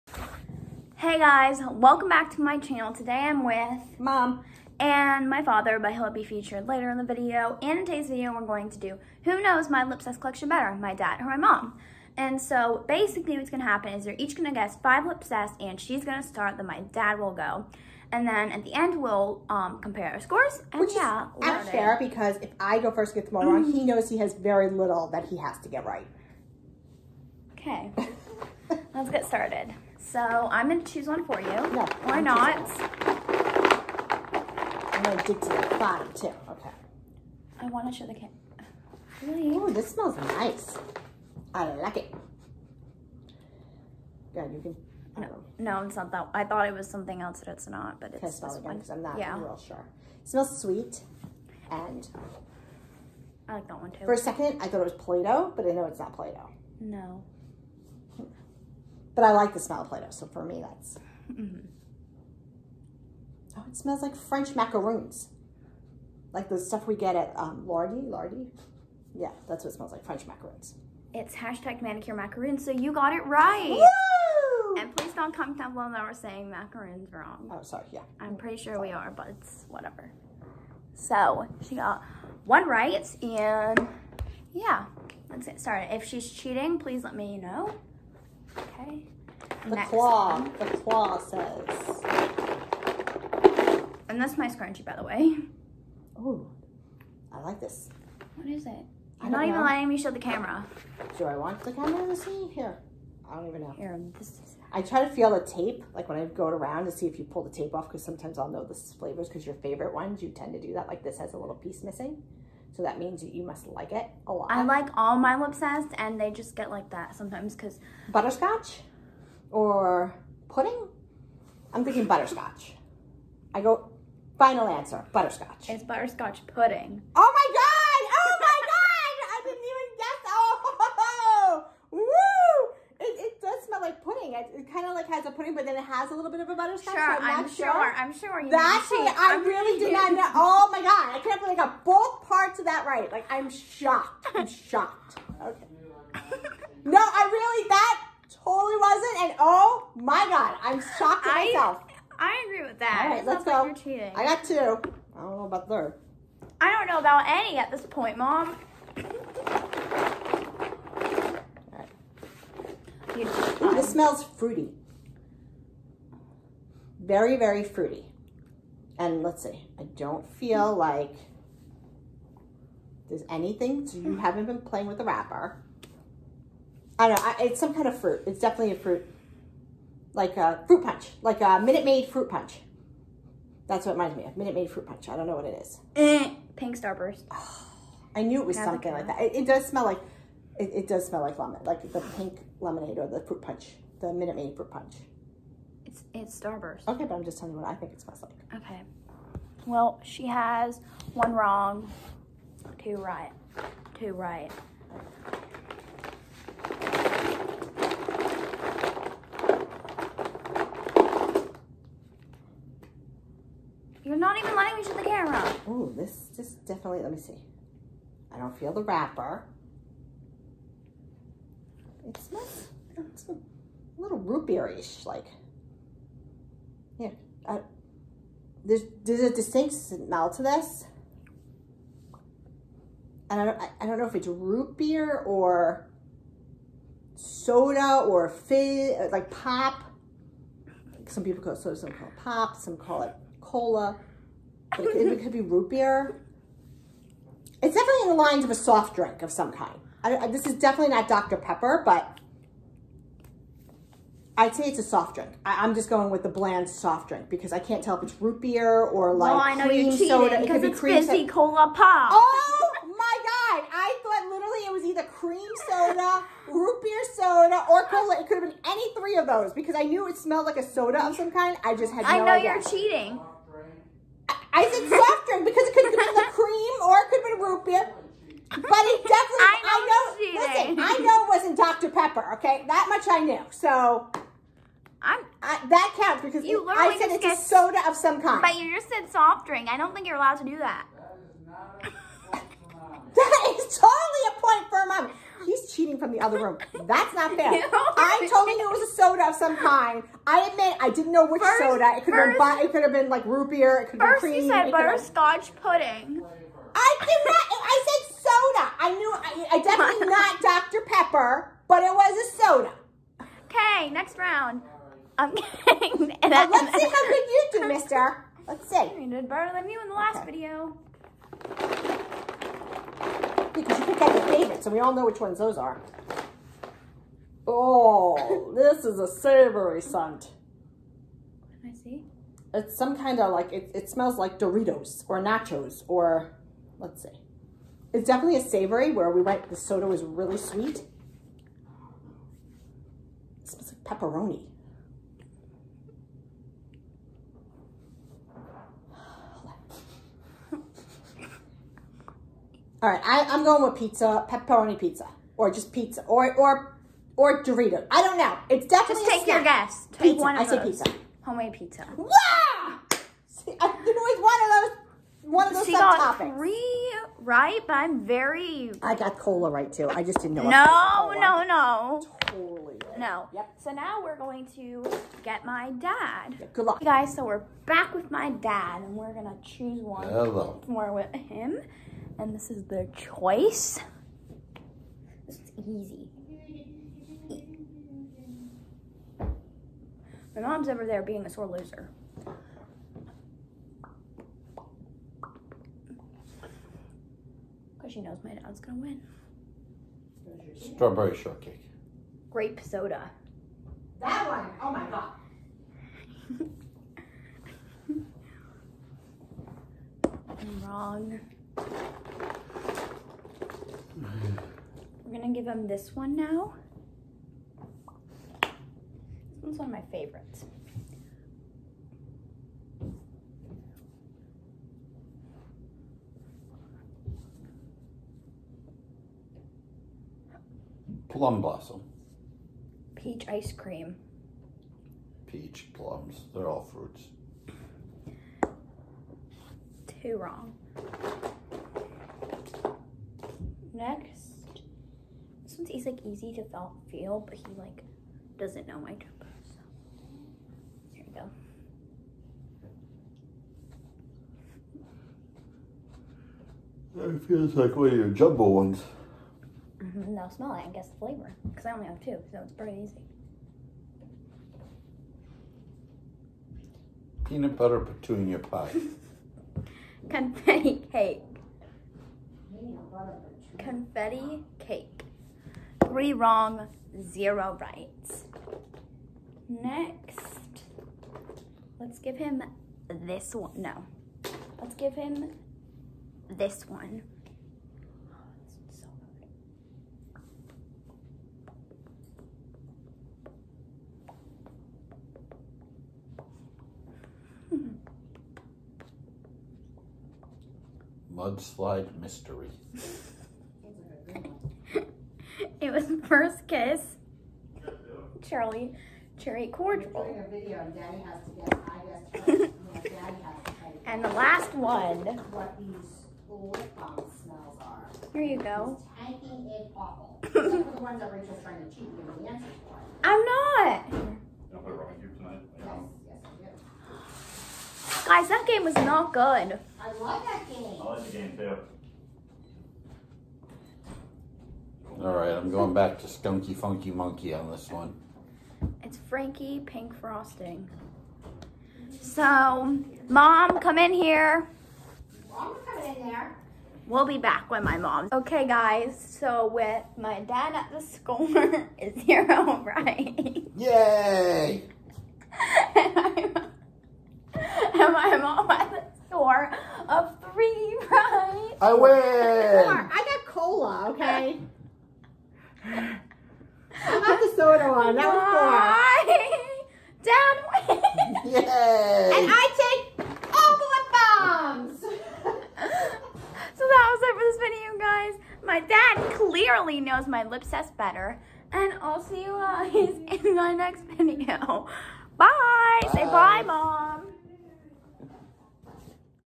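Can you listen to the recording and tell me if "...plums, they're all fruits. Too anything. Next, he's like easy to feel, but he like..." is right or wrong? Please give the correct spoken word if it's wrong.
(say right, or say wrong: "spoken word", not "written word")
wrong: "wrong", not "anything".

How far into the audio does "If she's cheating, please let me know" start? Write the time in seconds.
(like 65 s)
85 s.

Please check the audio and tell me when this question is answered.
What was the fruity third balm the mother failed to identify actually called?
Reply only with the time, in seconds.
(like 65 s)
186 s.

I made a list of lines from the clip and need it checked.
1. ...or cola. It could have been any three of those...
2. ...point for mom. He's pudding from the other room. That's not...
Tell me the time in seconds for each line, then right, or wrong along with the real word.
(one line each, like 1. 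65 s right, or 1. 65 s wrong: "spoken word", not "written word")
1. 267 s right
2. 294 s wrong: "cheating", not "pudding".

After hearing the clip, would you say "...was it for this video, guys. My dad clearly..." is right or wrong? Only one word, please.
right.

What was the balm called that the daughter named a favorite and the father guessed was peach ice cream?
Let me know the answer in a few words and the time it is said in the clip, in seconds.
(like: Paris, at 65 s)
Plum blossom, at 431 s.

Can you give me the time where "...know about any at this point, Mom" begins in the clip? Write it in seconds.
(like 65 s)
156 s.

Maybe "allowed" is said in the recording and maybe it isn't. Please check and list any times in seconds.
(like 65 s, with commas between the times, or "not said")
290 s.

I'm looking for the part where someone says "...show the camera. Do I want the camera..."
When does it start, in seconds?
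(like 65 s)
99 s.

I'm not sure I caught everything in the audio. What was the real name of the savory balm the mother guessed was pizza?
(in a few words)
Homemade pizza.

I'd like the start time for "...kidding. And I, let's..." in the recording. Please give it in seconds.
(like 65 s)
315 s.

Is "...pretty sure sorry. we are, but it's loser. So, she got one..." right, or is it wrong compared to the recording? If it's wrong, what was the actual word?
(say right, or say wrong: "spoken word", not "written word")
wrong: "whatever", not "loser".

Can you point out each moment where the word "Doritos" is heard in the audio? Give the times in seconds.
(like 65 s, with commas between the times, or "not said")
334 s, 357 s.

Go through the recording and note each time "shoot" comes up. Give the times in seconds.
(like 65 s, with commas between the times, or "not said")
214 s.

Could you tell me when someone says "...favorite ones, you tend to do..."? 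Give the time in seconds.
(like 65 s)
109 s.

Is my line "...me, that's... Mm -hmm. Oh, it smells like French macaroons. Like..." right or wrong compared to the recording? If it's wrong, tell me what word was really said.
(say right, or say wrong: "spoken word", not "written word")
right.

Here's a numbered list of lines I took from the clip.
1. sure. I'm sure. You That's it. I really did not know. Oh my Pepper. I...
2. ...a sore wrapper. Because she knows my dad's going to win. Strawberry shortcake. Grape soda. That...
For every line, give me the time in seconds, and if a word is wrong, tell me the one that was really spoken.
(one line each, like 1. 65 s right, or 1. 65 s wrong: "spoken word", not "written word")
1. 137 s wrong: "God", not "Pepper"
2. 391 s wrong: "loser", not "wrapper".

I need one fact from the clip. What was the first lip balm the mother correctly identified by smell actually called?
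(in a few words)
Manicure macaroons.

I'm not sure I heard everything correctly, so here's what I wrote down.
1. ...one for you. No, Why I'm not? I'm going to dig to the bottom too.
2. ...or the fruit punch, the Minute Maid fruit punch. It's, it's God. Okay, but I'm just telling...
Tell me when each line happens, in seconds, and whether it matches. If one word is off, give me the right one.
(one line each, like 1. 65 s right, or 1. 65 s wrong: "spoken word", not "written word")
1. 31 s right
2. 192 s wrong: "Starburst", not "God".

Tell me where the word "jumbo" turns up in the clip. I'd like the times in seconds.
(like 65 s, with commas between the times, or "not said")
448 s, 458 s.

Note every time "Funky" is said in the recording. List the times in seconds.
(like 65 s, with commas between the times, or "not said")
536 s.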